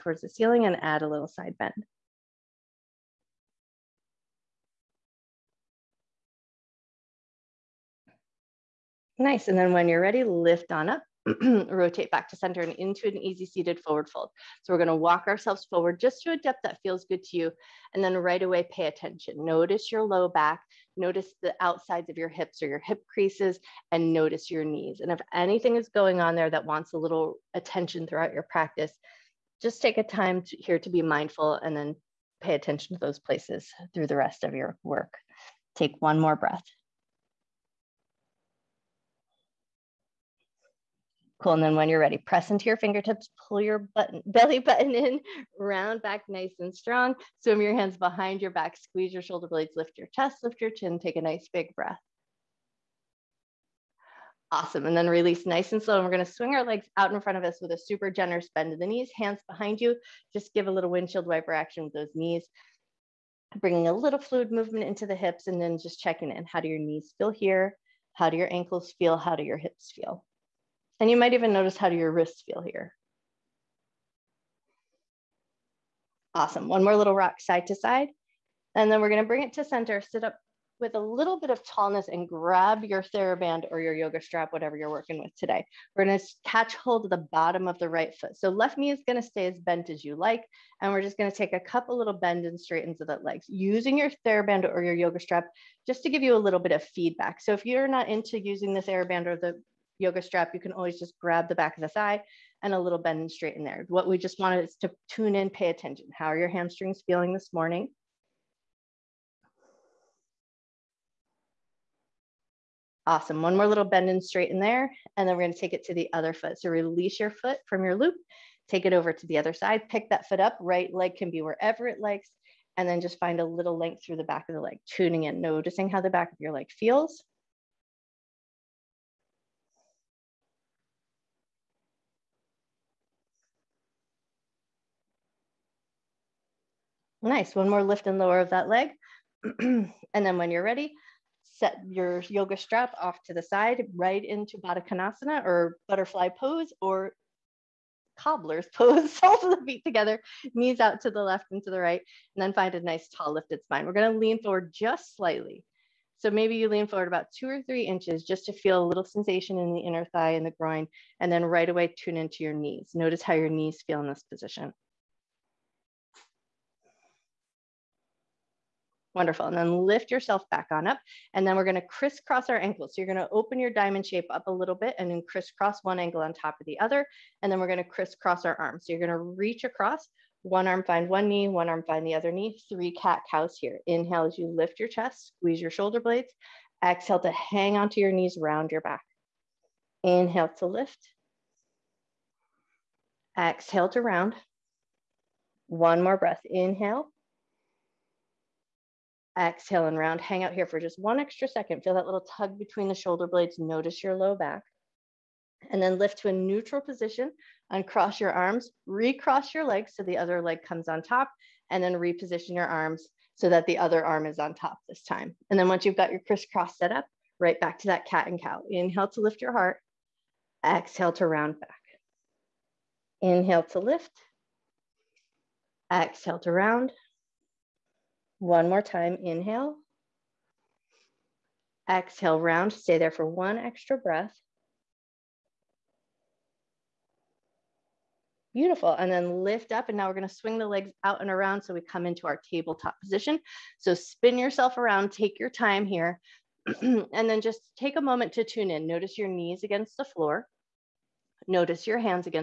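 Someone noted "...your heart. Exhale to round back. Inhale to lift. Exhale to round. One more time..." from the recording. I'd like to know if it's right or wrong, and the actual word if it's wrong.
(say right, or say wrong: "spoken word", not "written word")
right.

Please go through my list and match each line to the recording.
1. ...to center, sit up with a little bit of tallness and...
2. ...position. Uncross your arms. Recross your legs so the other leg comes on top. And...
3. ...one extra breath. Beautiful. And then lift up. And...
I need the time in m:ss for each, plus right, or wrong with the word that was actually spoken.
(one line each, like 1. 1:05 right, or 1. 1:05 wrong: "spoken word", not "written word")
1. 1:19 right
2. 3:26 right
3. 3:53 right.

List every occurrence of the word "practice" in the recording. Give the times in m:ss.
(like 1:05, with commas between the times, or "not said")
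0:28.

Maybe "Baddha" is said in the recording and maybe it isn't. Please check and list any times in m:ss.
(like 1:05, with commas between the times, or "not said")
2:24.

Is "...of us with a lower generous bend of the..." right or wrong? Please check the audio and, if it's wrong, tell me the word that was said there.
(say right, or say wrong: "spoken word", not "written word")
wrong: "super", not "lower".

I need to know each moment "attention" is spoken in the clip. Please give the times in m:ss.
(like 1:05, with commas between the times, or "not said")
0:18, 0:27, 0:32, 1:45.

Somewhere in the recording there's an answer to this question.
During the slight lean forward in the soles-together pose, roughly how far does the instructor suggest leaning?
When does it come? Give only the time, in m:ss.
2:37.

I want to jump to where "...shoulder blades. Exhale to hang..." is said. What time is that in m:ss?
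3:05.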